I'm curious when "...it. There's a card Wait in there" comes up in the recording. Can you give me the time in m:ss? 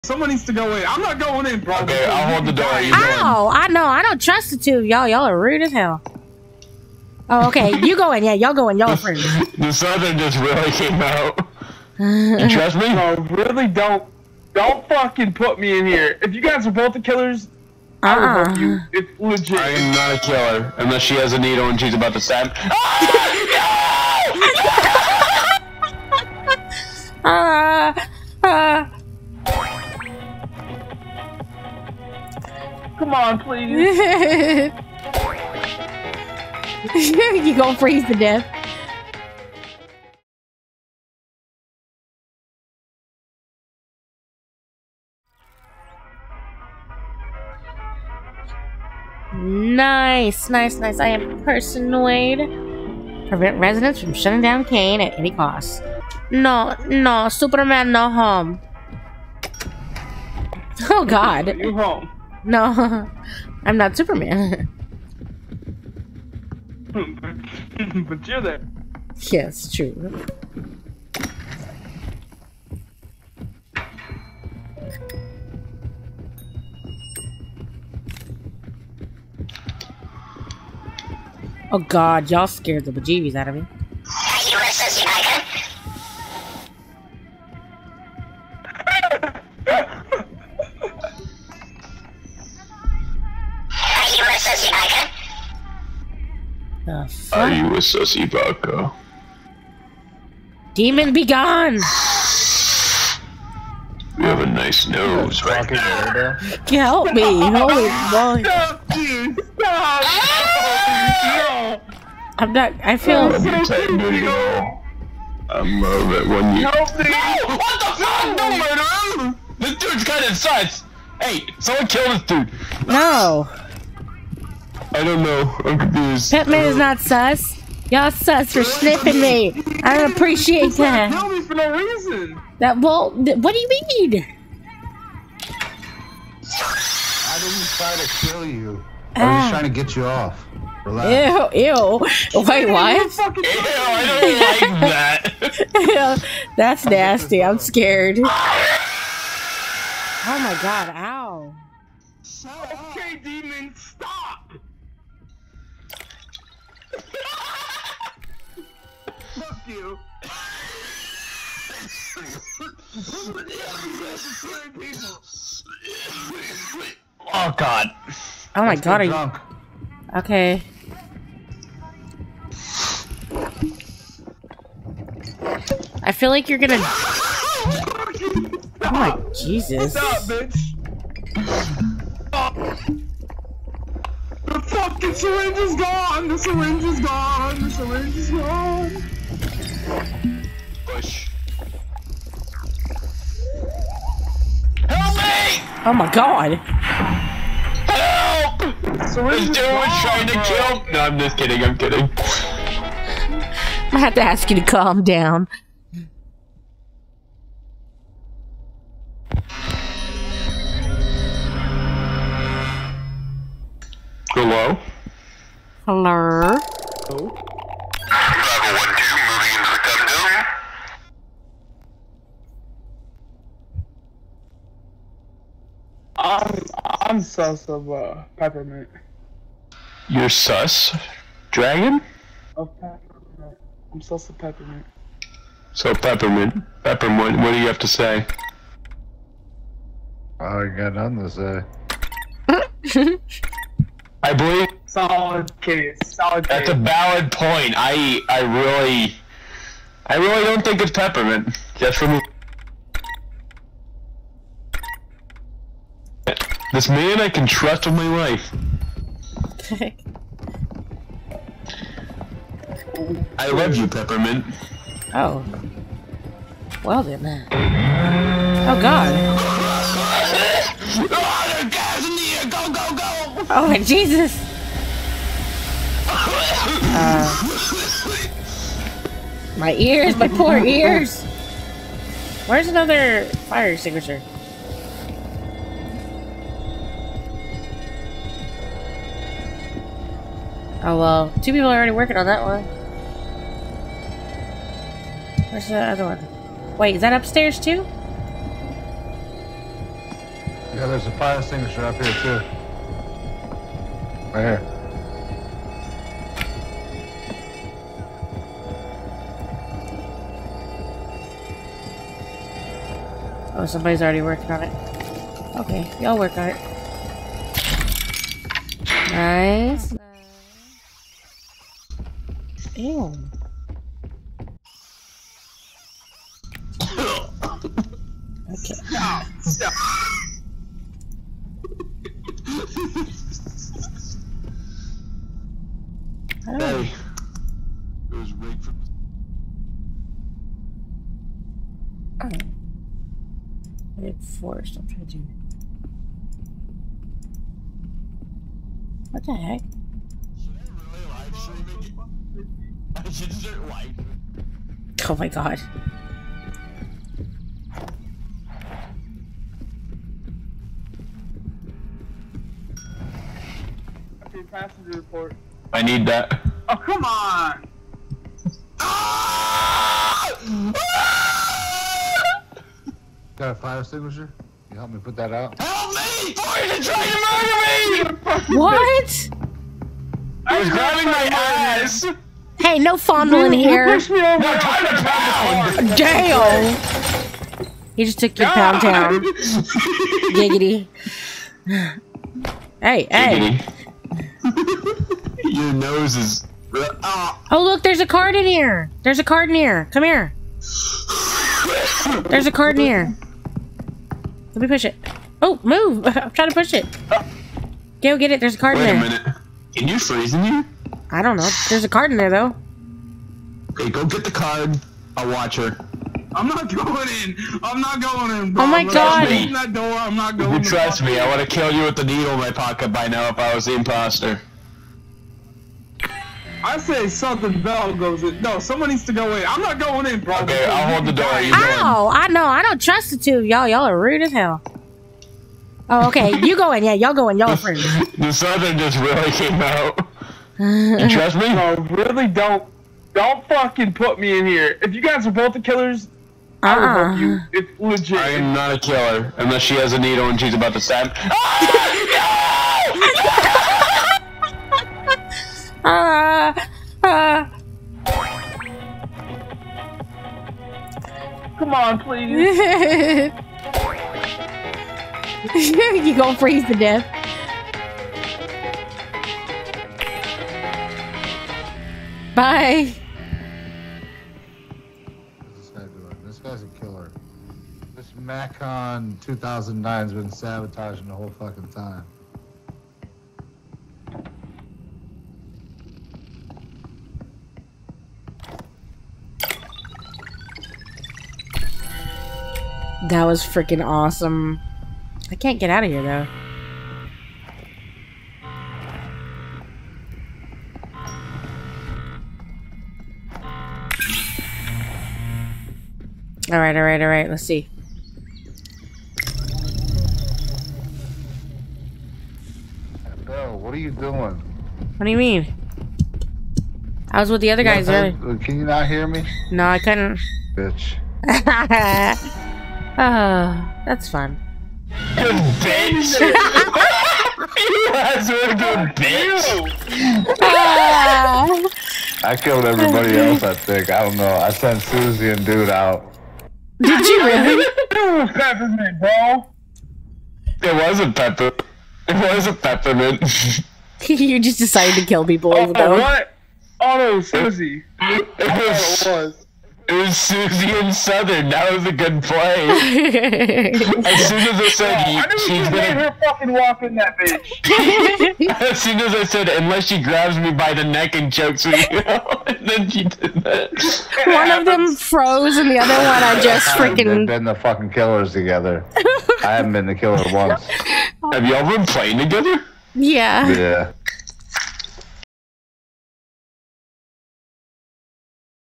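6:48.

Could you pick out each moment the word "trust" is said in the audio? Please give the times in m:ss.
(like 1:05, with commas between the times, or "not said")
0:04, 0:12, 4:17, 7:00, 7:12, 7:21.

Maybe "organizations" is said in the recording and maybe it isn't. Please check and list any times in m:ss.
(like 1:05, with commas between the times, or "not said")
not said.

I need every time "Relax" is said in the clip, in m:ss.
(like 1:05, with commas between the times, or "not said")
2:20.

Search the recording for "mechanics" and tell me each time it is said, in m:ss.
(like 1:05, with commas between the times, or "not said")
not said.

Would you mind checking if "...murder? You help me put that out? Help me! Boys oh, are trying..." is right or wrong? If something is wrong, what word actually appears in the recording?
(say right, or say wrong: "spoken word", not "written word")
wrong: "extinguisher", not "murder".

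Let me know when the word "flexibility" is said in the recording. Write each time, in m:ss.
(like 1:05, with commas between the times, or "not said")
not said.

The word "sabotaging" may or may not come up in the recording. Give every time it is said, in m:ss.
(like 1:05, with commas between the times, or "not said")
8:00.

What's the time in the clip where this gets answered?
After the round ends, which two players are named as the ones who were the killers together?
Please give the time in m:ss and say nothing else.
9:10.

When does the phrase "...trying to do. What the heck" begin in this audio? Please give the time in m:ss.
5:44.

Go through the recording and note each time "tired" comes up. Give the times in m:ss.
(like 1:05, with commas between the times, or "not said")
1:53.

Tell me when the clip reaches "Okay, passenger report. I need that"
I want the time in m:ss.
6:04.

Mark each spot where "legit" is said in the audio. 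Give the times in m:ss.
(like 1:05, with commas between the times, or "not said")
0:19, 7:27.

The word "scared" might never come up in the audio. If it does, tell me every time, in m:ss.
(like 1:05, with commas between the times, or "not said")
1:22, 2:27.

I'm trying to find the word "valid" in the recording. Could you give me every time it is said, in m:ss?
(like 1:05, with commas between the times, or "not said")
4:06.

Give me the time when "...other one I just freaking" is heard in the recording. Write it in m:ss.
9:25.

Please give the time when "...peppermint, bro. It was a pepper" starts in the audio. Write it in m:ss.
8:58.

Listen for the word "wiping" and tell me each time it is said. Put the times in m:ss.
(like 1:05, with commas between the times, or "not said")
5:53.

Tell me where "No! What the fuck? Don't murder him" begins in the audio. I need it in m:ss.
1:57.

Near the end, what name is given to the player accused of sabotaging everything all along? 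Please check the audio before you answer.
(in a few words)
Macon 2009.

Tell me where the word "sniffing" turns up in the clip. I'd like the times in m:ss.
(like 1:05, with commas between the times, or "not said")
2:08.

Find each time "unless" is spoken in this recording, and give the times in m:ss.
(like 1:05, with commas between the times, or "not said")
0:20, 7:29, 9:19.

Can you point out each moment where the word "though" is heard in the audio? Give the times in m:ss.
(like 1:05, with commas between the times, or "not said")
6:52, 8:16, 9:05.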